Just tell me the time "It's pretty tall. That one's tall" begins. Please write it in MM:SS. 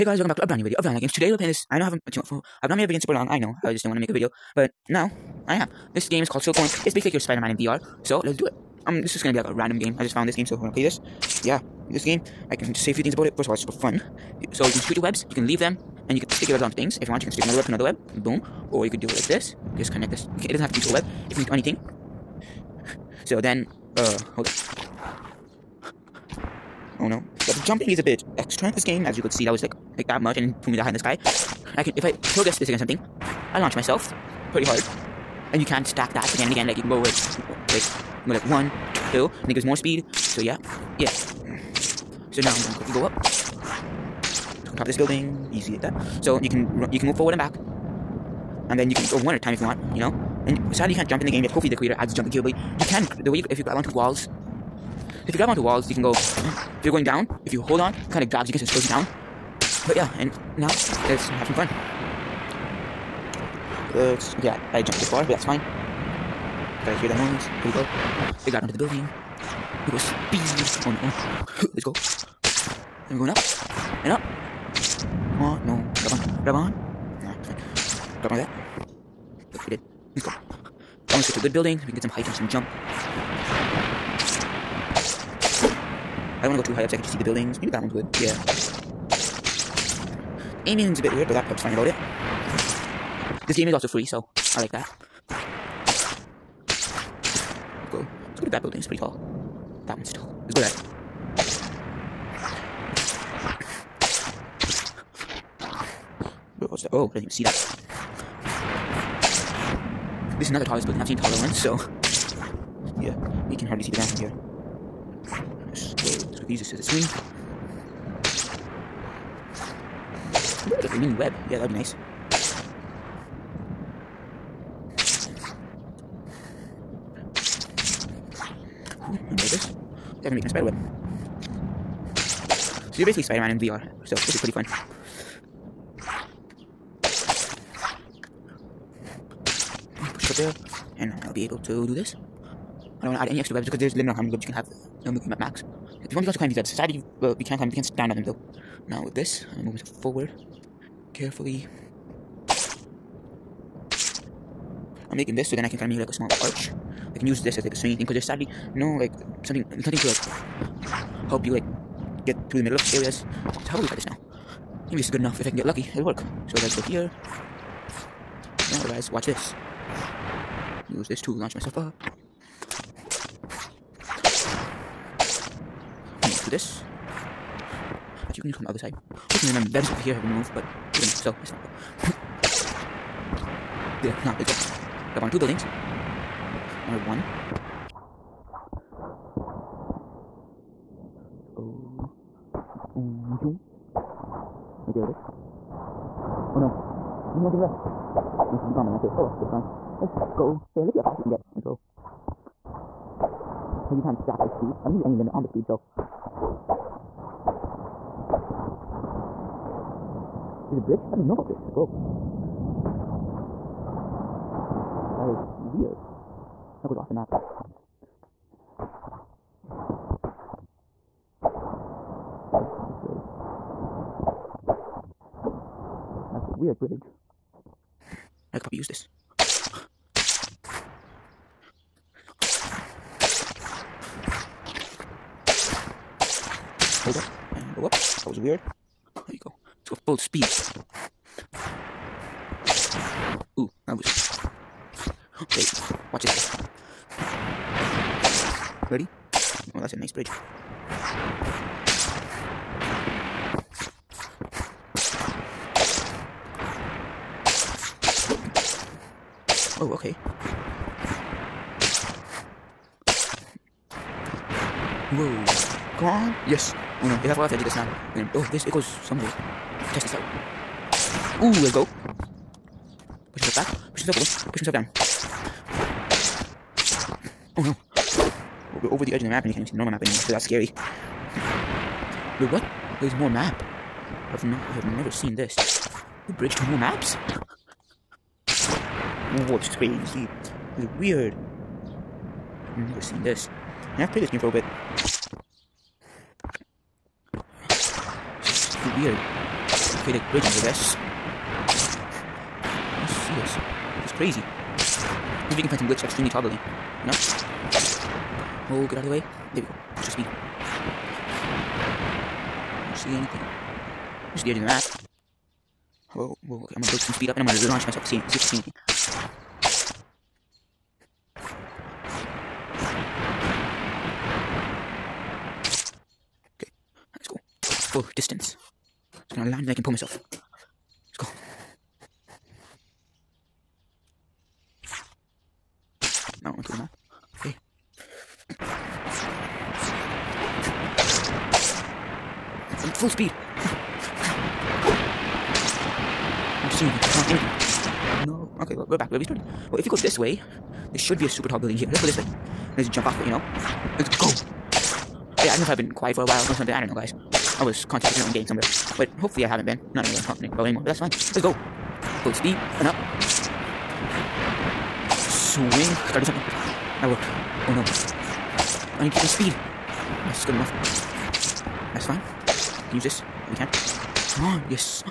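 01:38.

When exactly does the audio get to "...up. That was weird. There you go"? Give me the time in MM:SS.
03:57.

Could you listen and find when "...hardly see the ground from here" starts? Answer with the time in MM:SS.
01:53.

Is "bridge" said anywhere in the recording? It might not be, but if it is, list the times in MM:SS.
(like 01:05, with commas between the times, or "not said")
03:30, 03:46, 04:10, 04:46, 05:00.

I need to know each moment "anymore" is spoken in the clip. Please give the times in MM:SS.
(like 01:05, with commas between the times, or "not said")
04:40, 06:00.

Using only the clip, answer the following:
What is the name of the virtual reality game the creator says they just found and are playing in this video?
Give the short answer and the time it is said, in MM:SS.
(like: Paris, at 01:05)
Silkworm, at 00:06.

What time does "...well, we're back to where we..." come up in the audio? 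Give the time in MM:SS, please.
05:48.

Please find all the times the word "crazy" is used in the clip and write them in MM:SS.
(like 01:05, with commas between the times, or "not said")
04:49, 05:04.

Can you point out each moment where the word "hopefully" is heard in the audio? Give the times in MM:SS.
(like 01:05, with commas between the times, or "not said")
00:51, 02:59, 05:59.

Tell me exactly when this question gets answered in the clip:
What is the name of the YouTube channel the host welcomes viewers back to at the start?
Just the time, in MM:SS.
00:00.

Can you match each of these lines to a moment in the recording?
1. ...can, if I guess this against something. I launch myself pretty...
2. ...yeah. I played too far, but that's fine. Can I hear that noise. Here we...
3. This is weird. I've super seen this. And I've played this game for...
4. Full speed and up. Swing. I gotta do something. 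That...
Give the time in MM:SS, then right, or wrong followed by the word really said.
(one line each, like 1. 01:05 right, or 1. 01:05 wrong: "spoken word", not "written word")
1. 00:31 right
2. 01:04 wrong: "jumped", not "played"
3. 04:50 wrong: "never", not "super"
4. 06:02 right.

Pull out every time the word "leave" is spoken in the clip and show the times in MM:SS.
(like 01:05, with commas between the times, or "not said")
00:15.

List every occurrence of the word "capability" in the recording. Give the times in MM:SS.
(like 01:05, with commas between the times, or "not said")
00:52.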